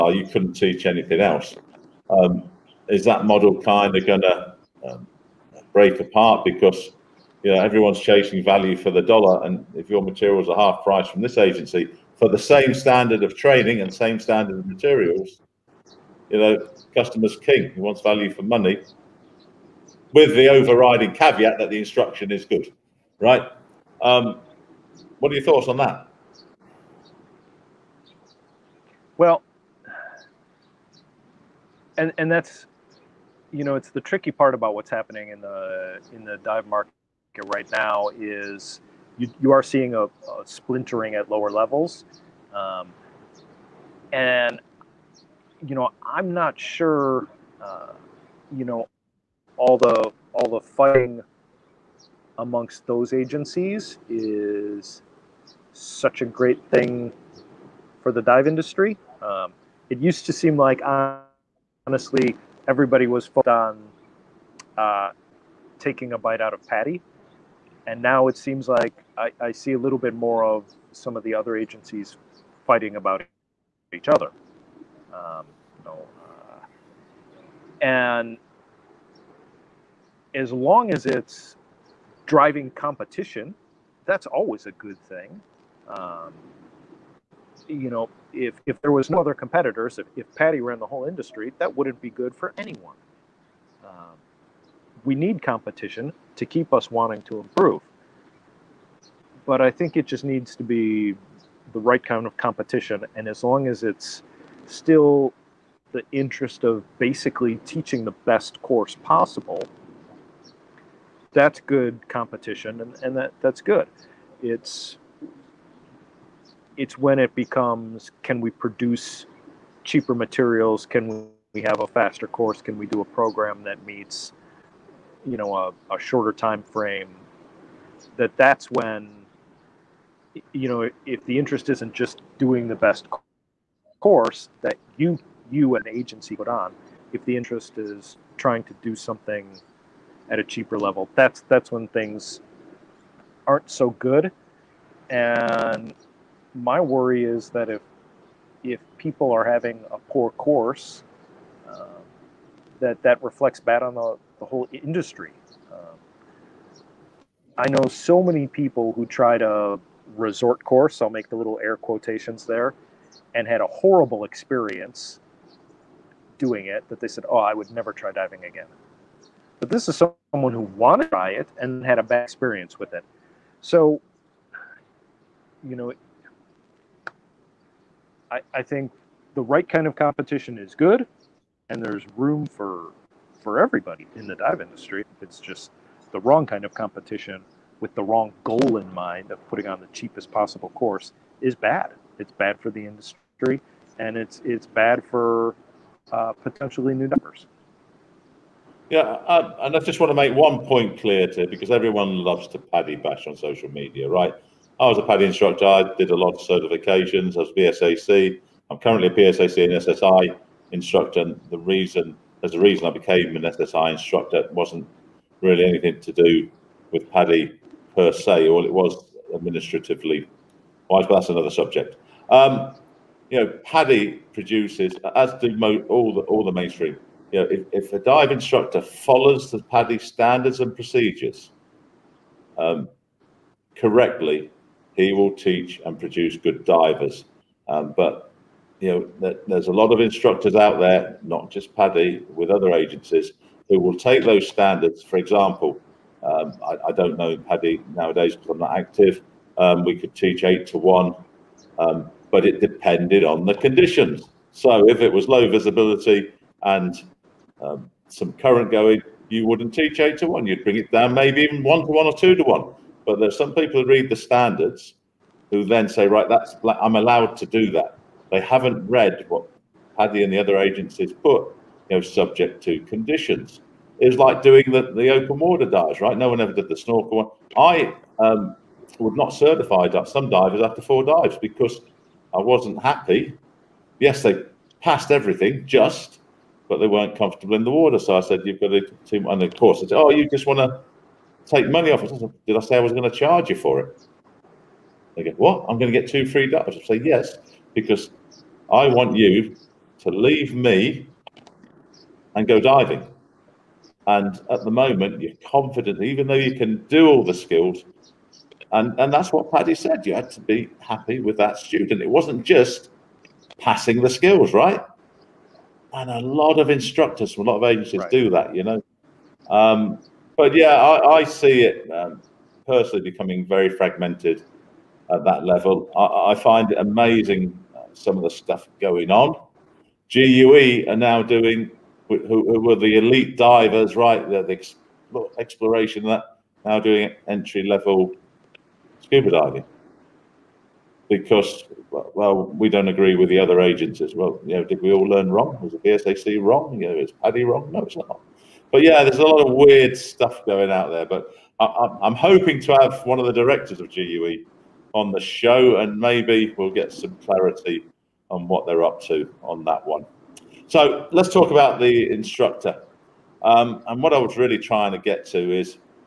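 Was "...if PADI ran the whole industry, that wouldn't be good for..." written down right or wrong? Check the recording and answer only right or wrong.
right.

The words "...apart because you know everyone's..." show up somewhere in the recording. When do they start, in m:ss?
0:05.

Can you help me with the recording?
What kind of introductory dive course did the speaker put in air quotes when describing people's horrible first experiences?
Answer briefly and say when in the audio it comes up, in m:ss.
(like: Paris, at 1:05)
resort course, at 2:40.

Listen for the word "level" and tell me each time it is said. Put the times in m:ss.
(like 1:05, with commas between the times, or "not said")
0:41, 2:20, 5:25, 5:37.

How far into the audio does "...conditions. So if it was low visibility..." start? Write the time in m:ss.
4:13.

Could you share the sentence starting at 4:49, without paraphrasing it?
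and of course, I said, Oh, you just want to take money off us.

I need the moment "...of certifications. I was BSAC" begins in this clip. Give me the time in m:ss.
3:26.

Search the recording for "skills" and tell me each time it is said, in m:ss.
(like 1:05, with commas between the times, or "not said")
5:07, 5:14.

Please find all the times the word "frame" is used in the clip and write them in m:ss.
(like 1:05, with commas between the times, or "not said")
2:06.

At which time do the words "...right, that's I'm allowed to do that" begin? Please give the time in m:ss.
4:26.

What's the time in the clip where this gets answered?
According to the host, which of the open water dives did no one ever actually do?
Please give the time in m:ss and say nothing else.
4:36.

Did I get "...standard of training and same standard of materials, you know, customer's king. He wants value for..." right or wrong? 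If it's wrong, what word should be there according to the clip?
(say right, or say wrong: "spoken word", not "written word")
right.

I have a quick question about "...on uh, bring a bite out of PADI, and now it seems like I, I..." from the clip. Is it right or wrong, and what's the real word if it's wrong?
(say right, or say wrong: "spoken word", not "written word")
wrong: "taking", not "bring".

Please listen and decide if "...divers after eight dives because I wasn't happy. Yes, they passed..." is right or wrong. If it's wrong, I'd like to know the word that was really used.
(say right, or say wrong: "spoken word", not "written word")
wrong: "four", not "eight".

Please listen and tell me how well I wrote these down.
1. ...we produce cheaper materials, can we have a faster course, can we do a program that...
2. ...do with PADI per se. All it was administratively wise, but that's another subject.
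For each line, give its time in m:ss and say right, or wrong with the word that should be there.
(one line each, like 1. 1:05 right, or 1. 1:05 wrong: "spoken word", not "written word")
1. 1:58 right
2. 3:36 right.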